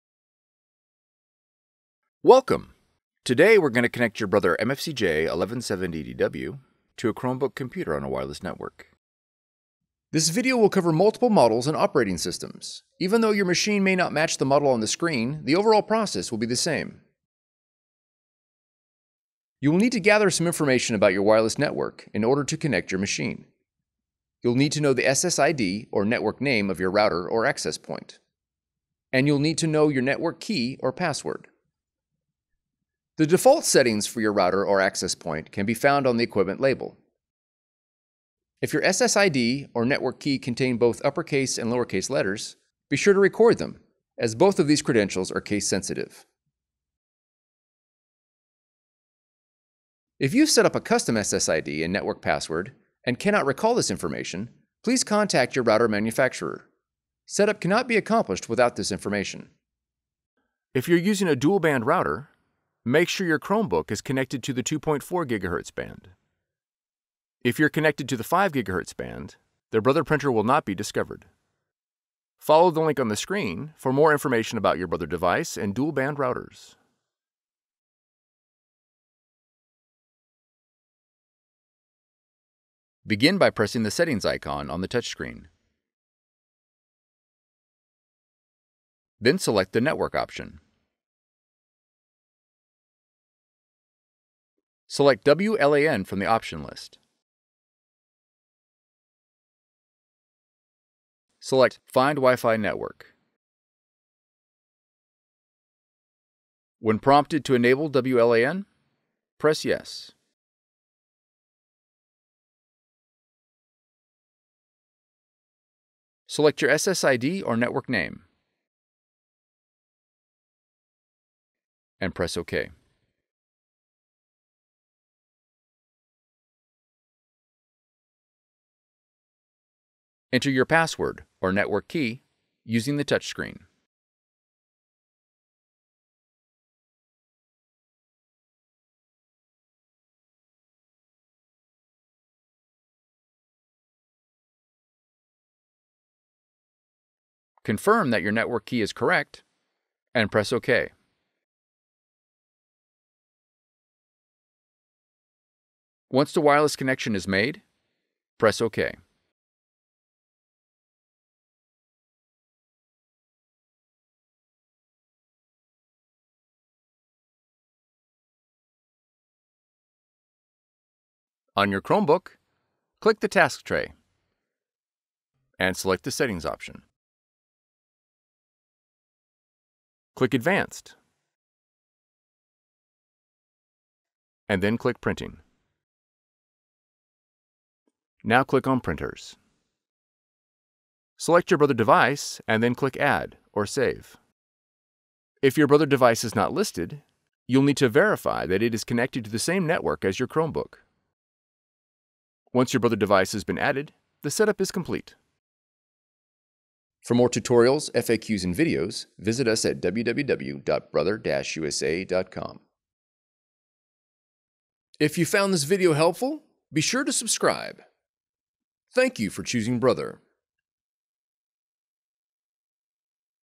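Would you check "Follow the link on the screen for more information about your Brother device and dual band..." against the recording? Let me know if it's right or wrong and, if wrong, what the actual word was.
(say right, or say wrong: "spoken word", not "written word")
right.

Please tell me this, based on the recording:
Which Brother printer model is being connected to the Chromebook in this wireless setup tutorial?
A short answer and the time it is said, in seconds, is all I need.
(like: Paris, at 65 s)
MFCJ1170DW, at 4 s.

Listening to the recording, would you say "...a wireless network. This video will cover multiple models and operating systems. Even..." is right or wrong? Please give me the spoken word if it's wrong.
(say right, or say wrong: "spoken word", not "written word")
right.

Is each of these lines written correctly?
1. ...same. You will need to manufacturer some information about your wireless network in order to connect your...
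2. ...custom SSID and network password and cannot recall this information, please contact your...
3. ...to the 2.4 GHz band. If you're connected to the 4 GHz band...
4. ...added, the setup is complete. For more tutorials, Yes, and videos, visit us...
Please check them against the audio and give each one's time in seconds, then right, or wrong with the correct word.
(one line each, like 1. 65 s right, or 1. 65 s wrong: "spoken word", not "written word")
1. 16 s wrong: "gather", not "manufacturer"
2. 50 s right
3. 64 s wrong: "5", not "4"
4. 203 s wrong: "FAQs", not "Yes".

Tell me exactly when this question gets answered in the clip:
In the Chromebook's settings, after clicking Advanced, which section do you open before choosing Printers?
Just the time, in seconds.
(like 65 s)
185 s.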